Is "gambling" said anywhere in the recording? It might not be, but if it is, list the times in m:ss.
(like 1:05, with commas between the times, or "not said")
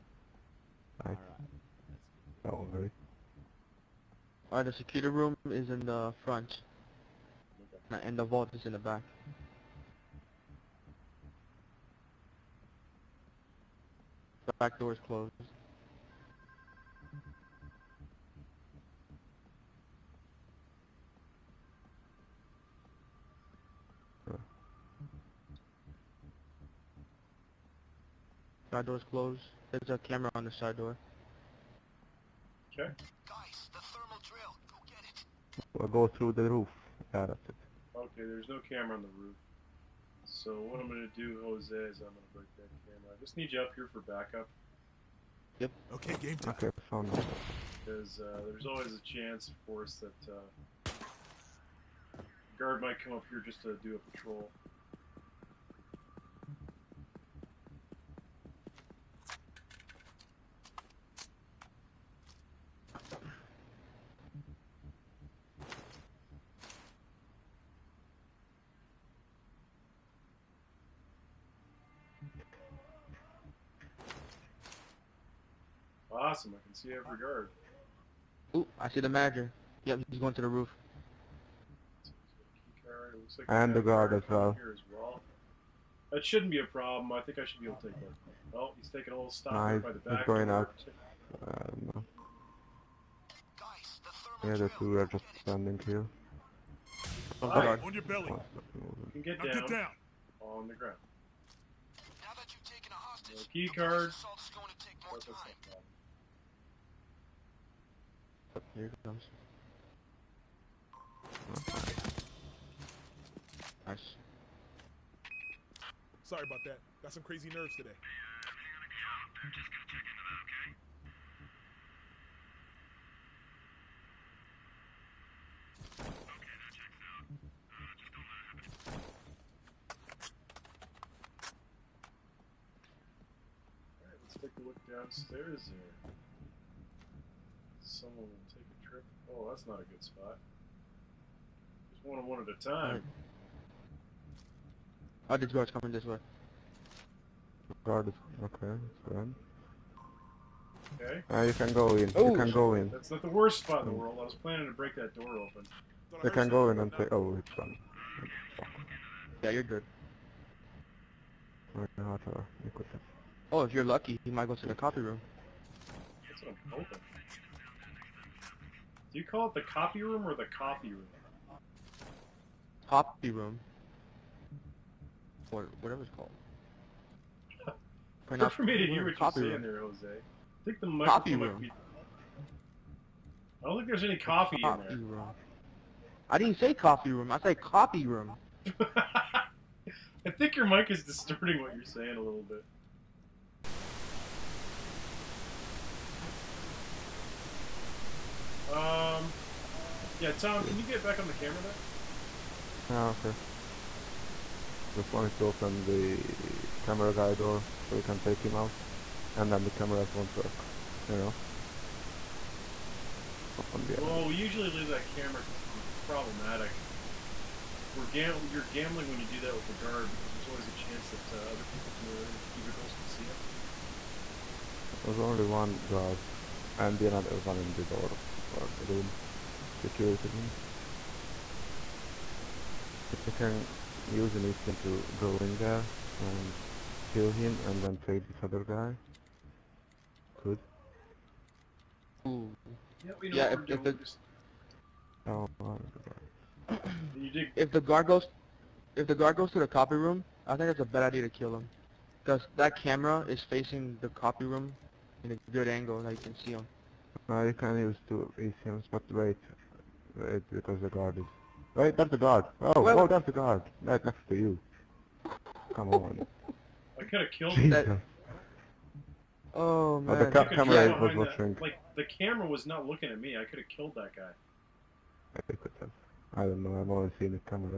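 3:38.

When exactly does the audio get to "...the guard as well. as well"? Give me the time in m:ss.
1:23.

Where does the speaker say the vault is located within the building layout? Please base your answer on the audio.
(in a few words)
In the back.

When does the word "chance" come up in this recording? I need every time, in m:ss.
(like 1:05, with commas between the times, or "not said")
0:49, 3:40.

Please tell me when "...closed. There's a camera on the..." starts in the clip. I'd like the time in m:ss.
0:29.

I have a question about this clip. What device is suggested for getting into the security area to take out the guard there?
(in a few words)
An ECM.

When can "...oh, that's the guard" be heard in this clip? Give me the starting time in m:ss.
4:23.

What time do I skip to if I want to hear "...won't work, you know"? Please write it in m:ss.
3:30.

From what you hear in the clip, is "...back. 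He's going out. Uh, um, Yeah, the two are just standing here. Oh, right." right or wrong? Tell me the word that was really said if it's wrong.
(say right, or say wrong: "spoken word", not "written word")
right.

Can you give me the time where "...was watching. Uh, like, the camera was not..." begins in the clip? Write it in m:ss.
4:31.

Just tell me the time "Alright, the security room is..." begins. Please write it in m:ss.
0:04.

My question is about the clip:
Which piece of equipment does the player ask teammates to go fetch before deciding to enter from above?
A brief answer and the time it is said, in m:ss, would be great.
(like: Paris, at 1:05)
Thermal drill, at 0:33.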